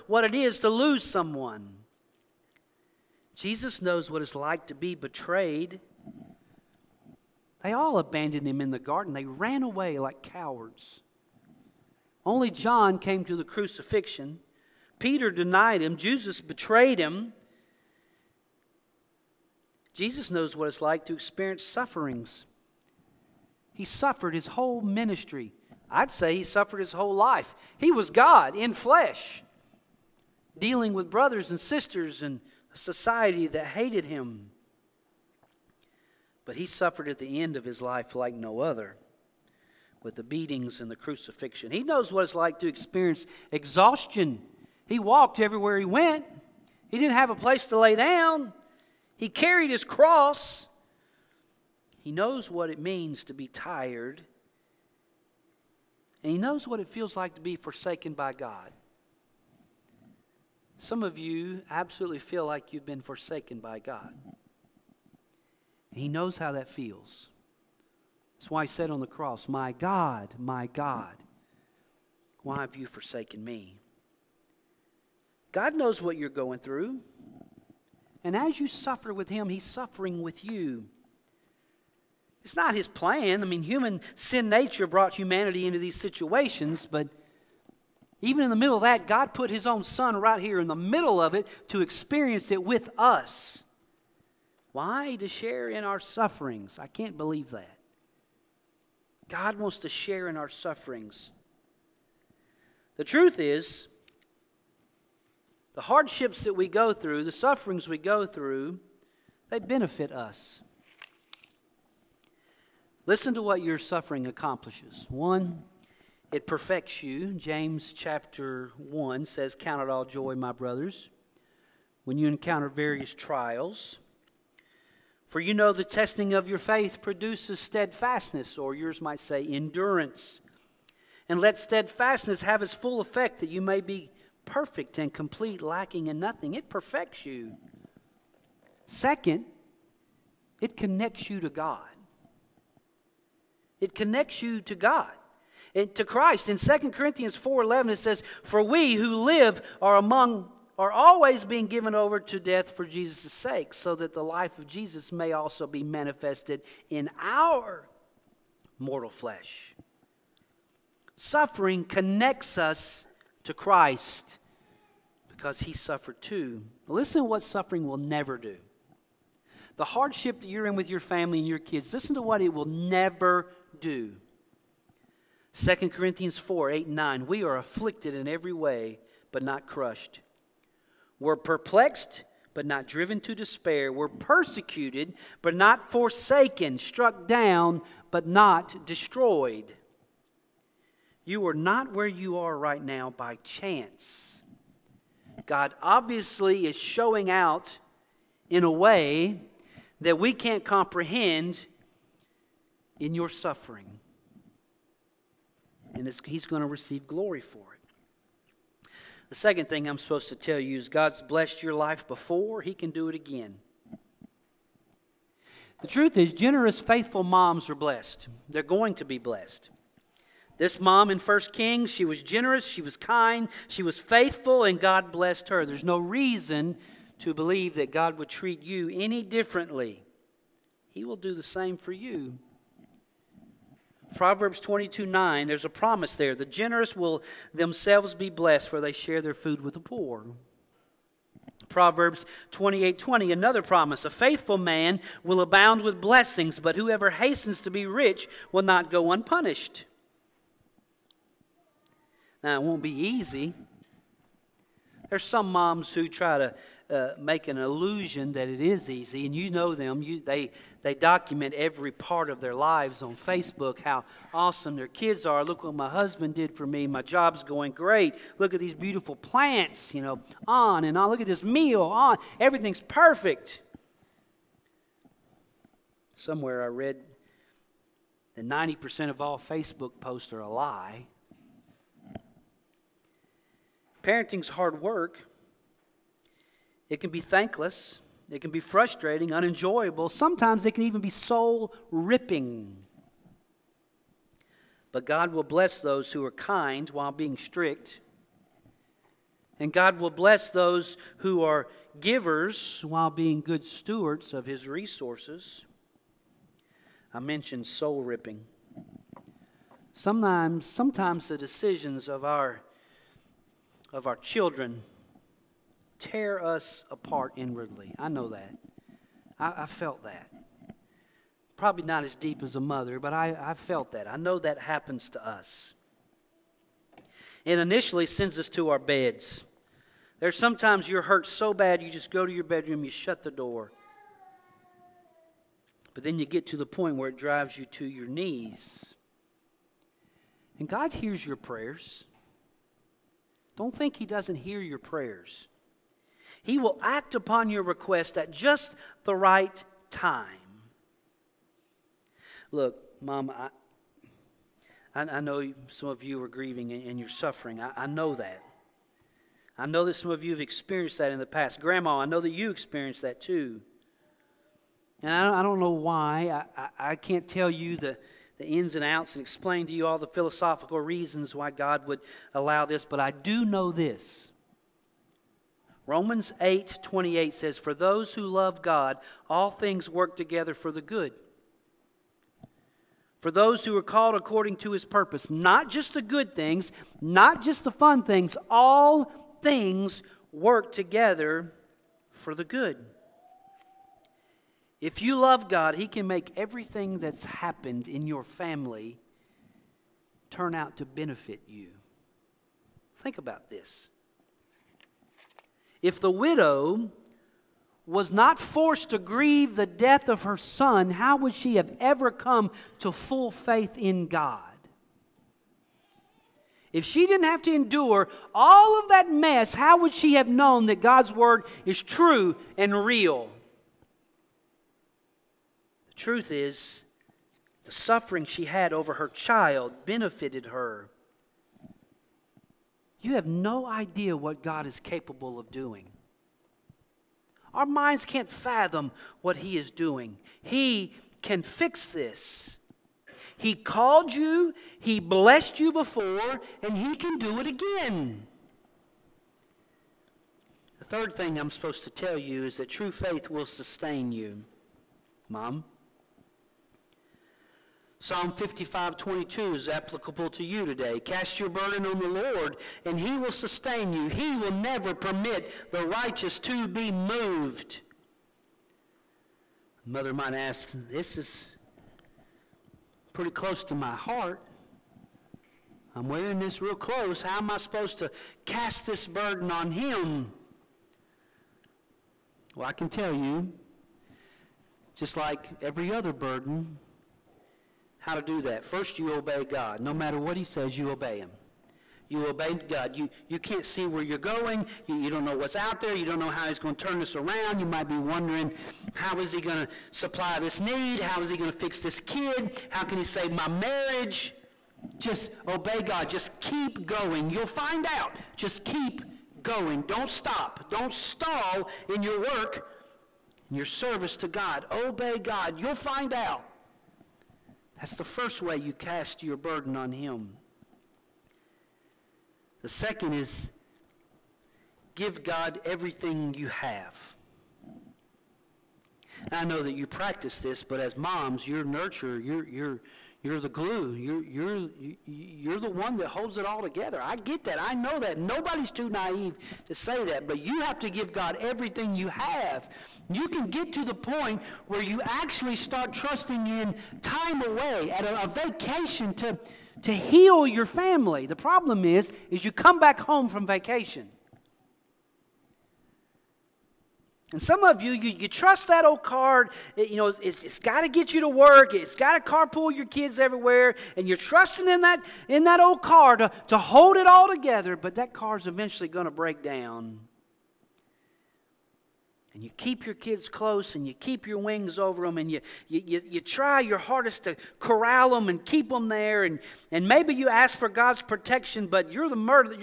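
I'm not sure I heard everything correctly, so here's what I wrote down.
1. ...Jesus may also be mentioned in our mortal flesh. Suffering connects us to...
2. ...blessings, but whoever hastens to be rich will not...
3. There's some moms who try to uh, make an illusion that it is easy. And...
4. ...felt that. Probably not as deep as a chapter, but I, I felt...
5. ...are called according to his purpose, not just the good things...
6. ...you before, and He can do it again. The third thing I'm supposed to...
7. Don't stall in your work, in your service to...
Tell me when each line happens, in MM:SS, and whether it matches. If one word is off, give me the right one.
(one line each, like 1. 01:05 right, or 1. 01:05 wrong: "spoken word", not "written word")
1. 02:34 wrong: "manifested", not "mentioned"
2. 04:05 right
3. 04:15 right
4. 05:19 wrong: "mother", not "chapter"
5. 06:23 right
6. 07:25 right
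7. 08:30 right.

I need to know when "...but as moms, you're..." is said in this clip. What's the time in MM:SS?
08:50.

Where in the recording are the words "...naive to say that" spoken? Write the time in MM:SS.
08:58.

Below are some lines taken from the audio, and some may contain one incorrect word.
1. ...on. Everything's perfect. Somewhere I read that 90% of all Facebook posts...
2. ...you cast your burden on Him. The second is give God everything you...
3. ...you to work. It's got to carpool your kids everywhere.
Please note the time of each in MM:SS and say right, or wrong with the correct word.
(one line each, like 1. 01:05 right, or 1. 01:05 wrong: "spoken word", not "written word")
1. 04:31 right
2. 08:38 right
3. 09:21 right.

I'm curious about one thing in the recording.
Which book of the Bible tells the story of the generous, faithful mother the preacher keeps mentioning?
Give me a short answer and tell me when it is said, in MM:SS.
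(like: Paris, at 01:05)
First Kings, at 03:41.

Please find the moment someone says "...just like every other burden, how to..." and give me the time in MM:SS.
08:04.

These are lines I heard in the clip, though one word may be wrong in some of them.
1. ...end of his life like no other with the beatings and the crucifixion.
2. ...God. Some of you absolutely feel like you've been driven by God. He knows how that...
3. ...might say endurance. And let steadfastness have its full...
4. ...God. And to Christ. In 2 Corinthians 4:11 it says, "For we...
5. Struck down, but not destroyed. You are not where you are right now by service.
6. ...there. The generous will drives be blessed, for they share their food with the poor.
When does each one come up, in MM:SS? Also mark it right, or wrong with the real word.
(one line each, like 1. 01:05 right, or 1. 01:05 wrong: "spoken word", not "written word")
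1. 00:37 right
2. 00:58 wrong: "forsaken", not "driven"
3. 02:09 right
4. 02:24 right
5. 03:06 wrong: "chance", not "service"
6. 03:56 wrong: "themselves", not "drives".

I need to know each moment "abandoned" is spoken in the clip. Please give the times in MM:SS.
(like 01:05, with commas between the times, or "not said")
00:07.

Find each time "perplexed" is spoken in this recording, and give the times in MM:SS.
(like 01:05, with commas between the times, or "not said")
03:01.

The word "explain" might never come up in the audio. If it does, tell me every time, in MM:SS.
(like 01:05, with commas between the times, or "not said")
06:09.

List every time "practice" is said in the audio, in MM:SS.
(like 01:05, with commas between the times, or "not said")
08:49.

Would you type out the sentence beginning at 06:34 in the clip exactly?
If you love God, he can make everything that's happened in your family turn out to benefit you.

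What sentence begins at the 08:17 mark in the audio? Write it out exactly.
You might be wondering, how is He going to supply this need?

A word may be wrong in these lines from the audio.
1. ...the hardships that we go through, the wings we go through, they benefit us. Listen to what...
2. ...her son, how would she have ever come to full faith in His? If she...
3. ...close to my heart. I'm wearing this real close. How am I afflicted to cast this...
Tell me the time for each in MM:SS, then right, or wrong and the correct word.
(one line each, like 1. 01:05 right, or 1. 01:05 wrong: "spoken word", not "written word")
1. 01:45 wrong: "sufferings", not "wings"
2. 06:50 wrong: "God", not "His"
3. 07:53 wrong: "supposed", not "afflicted".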